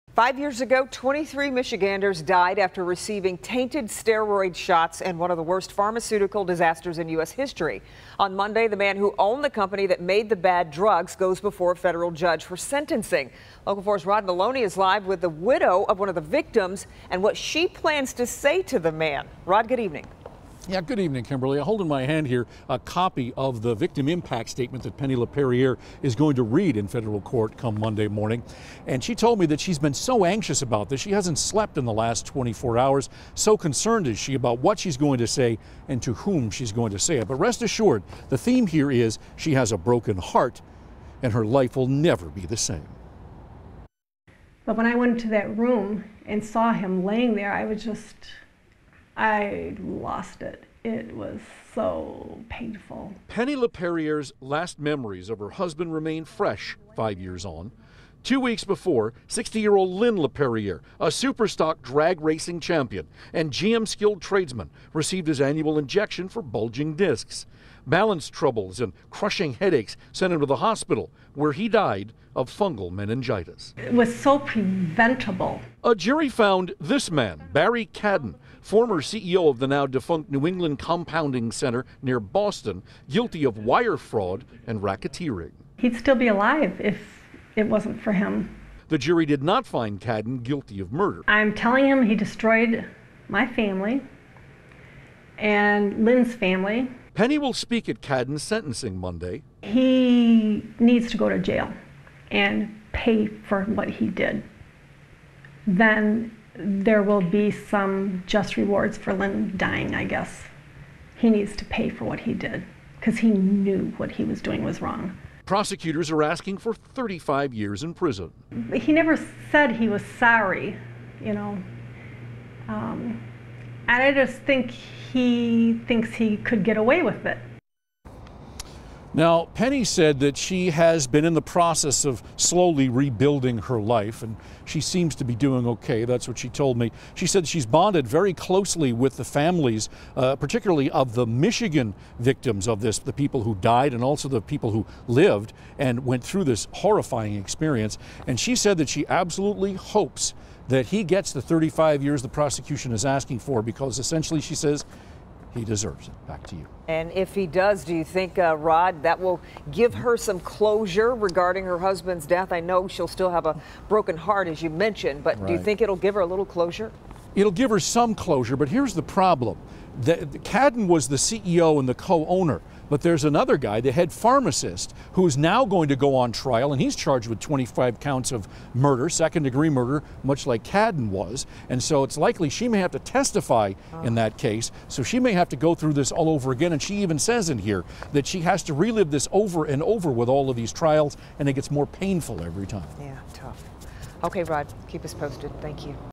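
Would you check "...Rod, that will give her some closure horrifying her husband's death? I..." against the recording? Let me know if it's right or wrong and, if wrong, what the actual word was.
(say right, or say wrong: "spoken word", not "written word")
wrong: "regarding", not "horrifying".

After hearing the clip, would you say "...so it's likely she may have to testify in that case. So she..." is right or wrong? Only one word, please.
right.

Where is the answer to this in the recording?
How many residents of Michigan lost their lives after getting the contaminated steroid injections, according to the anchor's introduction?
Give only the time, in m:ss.
0:00.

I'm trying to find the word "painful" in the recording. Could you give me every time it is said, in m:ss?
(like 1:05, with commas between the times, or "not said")
0:52, 3:11.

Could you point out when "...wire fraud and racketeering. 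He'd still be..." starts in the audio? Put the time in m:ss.
1:23.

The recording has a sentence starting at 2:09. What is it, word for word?
Now, Penny said that she has been in the process of slowly rebuilding her life, and she seems to be doing okay.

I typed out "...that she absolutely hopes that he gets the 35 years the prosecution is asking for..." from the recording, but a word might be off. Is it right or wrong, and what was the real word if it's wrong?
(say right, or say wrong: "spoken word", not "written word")
right.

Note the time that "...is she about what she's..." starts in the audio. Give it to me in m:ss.
0:34.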